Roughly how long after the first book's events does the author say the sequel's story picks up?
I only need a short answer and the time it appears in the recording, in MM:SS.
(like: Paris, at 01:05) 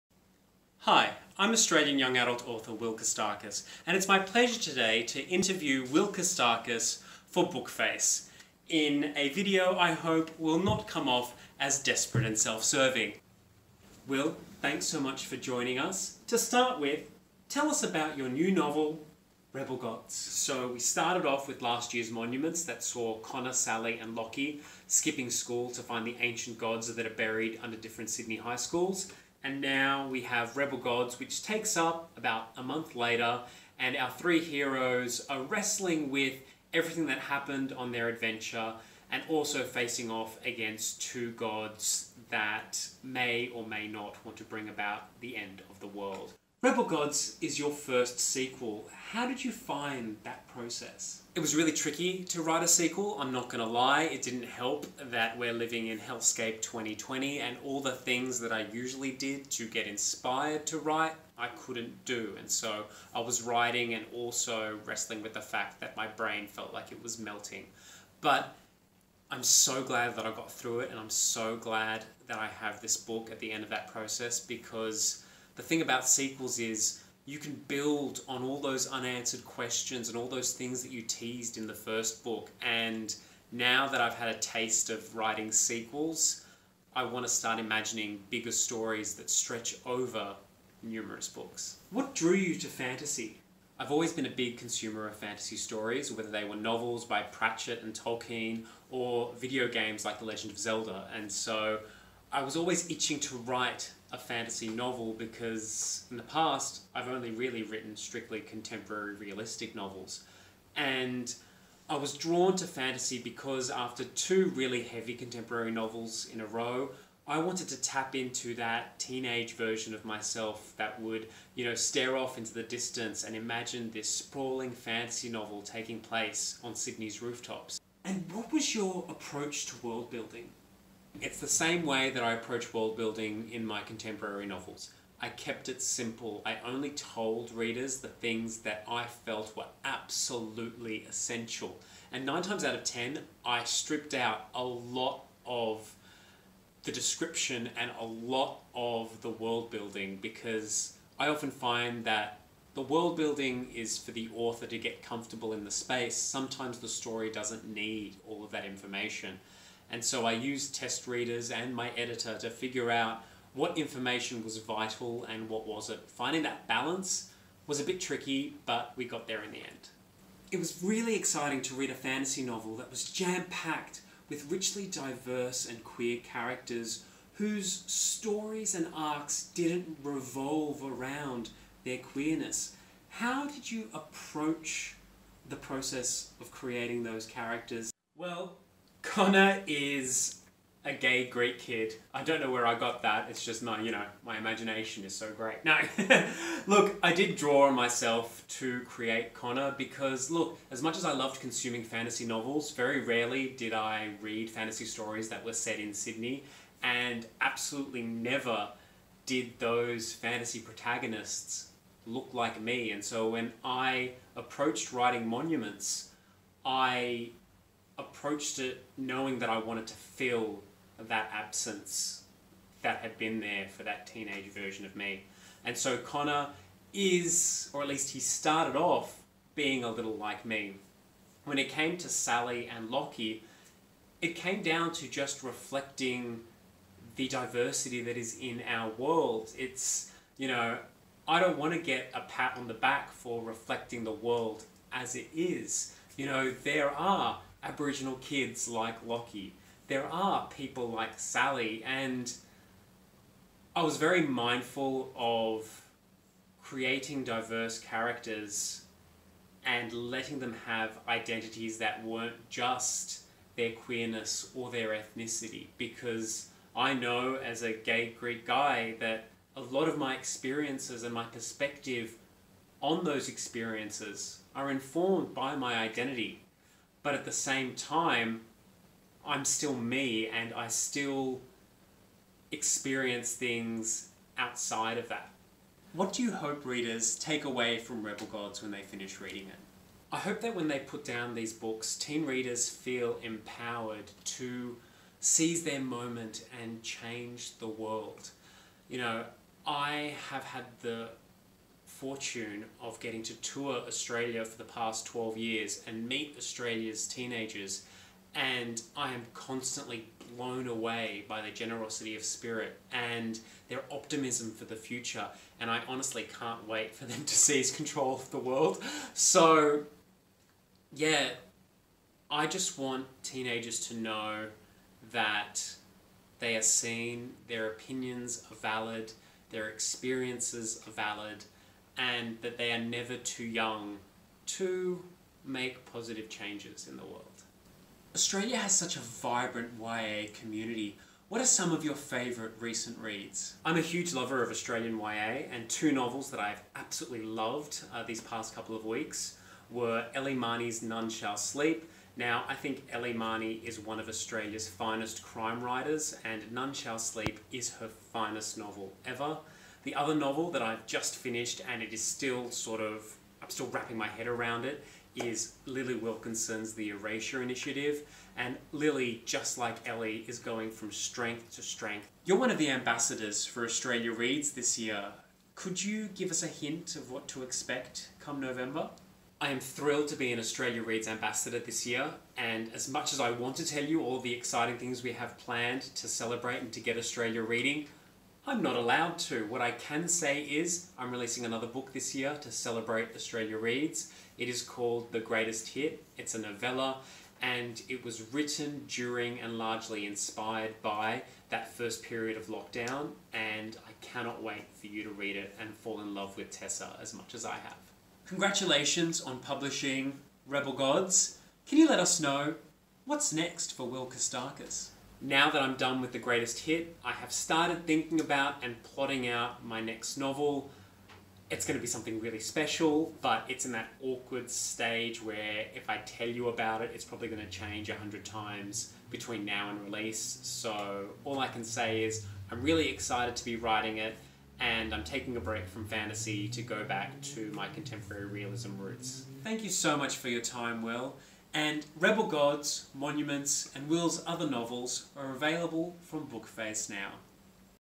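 a month later, at 00:32.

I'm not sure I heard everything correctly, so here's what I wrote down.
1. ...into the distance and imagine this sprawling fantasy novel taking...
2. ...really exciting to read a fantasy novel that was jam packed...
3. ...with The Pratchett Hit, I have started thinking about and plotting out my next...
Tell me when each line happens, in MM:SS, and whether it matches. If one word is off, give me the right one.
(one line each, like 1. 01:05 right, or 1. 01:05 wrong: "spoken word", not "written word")
1. 02:02 right
2. 02:50 right
3. 06:56 wrong: "Greatest", not "Pratchett".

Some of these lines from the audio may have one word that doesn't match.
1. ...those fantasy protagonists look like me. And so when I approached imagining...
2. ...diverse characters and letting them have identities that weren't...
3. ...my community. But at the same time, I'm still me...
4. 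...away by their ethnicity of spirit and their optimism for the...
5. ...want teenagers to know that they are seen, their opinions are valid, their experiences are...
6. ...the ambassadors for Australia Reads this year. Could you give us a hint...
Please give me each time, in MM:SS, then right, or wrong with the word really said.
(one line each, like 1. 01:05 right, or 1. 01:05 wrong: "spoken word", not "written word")
1. 03:29 wrong: "writing", not "imagining"
2. 04:17 right
3. 04:35 wrong: "identity", not "community"
4. 05:10 wrong: "generosity", not "ethnicity"
5. 05:22 right
6. 06:12 right.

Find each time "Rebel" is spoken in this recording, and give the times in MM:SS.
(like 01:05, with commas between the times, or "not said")
00:19, 00:30, 00:46, 04:48, 06:50, 07:21.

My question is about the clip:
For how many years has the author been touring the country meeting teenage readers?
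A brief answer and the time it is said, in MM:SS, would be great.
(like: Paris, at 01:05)
12, at 05:05.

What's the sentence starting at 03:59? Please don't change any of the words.
It's, you know, I don't want to get a pat on the back for reflecting the world as it is.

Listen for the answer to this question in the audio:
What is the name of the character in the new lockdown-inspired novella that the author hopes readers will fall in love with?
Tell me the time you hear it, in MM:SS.
06:46.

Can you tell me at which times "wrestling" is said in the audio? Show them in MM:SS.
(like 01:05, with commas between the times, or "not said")
00:35, 01:04.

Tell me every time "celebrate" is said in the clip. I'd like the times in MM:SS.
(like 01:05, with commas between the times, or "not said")
06:26, 06:32.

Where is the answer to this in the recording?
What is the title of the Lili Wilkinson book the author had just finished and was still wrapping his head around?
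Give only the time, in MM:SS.
06:06.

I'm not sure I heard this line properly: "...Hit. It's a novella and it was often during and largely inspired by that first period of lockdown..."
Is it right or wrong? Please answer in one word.
wrong.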